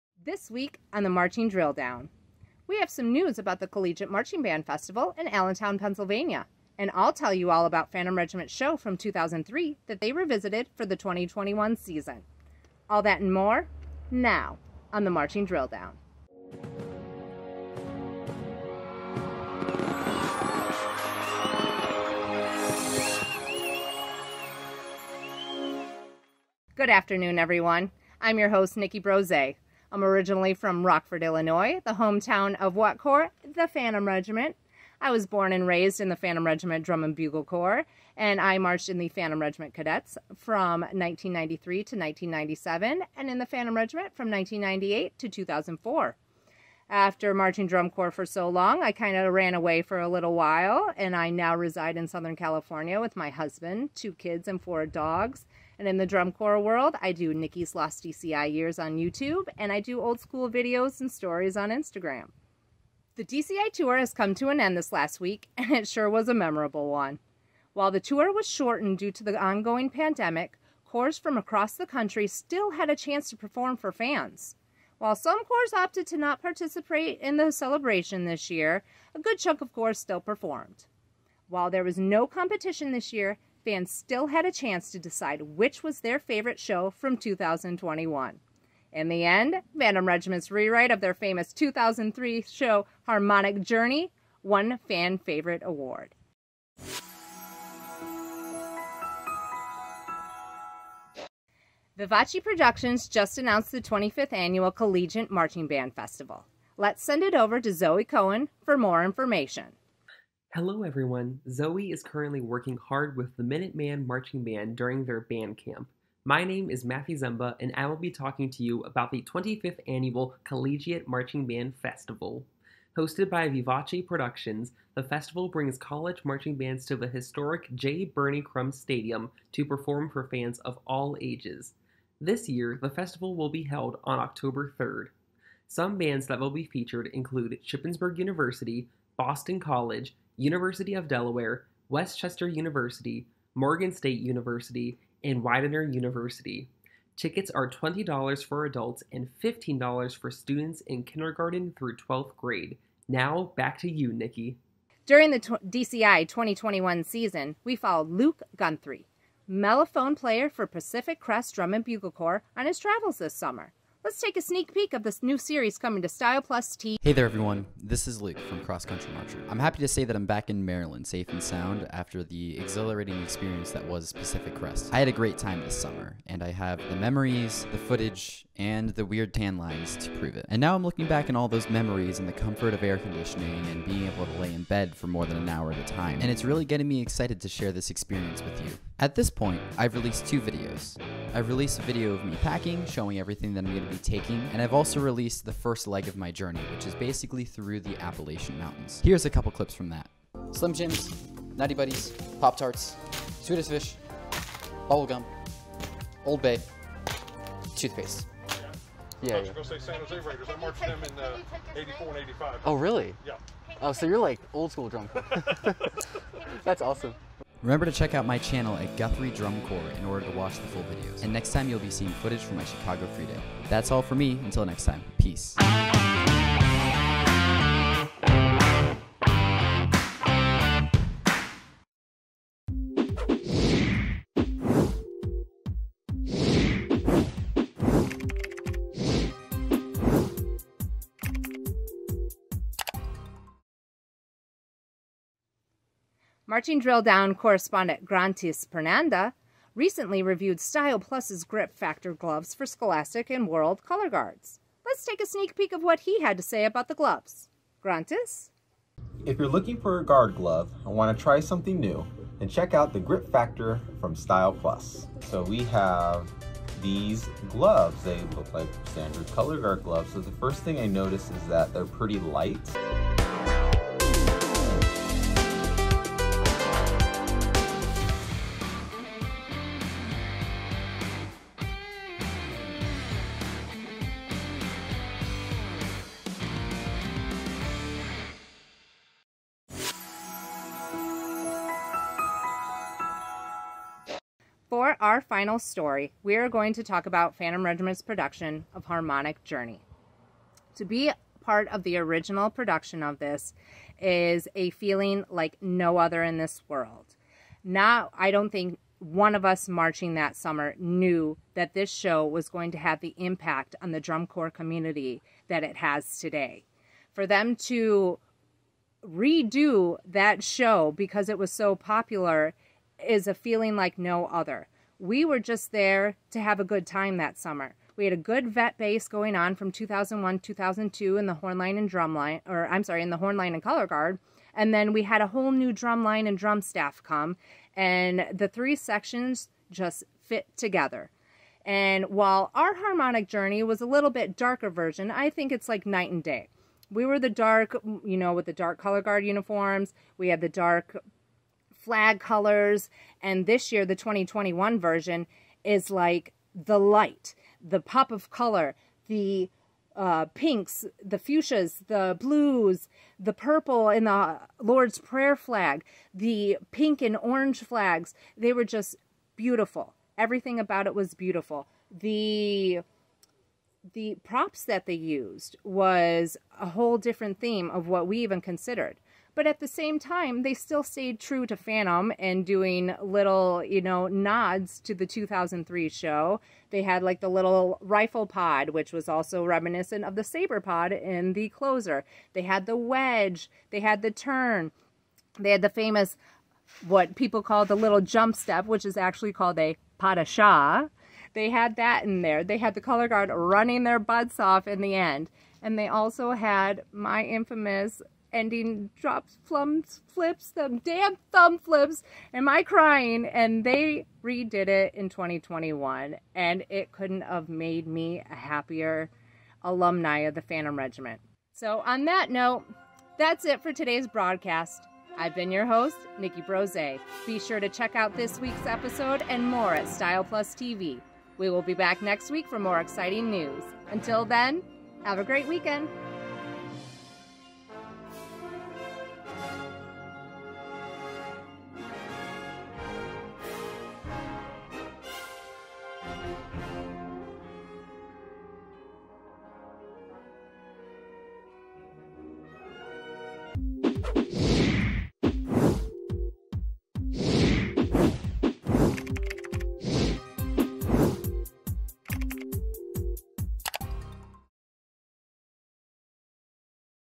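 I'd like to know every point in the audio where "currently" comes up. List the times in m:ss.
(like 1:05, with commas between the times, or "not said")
1:52.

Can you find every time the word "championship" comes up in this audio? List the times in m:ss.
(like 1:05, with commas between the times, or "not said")
not said.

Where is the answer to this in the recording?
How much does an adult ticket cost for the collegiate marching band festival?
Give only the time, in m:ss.
2:27.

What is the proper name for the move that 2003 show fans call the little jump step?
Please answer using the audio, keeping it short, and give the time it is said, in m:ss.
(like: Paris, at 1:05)
Pas de chat, at 6:39.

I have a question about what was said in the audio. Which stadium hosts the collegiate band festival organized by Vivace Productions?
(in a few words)
J. Birney Crum Stadium.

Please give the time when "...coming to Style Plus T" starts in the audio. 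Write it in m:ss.
2:45.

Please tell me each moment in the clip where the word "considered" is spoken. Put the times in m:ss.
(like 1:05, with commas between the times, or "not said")
6:18.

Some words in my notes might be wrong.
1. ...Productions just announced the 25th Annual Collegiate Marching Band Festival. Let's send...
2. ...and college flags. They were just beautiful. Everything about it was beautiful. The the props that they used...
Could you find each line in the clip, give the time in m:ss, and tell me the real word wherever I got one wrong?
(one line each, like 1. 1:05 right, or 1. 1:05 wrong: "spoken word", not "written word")
1. 1:42 right
2. 6:07 wrong: "orange", not "college".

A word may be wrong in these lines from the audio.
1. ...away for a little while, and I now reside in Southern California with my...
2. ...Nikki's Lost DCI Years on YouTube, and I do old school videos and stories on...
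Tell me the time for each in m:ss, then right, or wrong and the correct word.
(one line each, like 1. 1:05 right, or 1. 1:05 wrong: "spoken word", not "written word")
1. 0:49 right
2. 0:57 right.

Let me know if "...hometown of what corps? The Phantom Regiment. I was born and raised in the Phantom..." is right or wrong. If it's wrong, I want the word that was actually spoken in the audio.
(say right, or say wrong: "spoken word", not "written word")
right.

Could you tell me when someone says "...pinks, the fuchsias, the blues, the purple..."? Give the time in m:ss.
6:00.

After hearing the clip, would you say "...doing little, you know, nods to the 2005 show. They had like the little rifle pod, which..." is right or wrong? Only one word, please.
wrong.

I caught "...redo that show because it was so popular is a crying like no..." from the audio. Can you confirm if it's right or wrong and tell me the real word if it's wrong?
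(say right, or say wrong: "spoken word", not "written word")
wrong: "feeling", not "crying".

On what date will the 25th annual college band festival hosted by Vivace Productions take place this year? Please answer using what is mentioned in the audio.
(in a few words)
October 3rd.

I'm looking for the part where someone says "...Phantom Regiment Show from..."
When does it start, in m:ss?
0:07.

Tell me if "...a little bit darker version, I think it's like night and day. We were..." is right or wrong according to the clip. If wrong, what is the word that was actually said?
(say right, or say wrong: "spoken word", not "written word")
right.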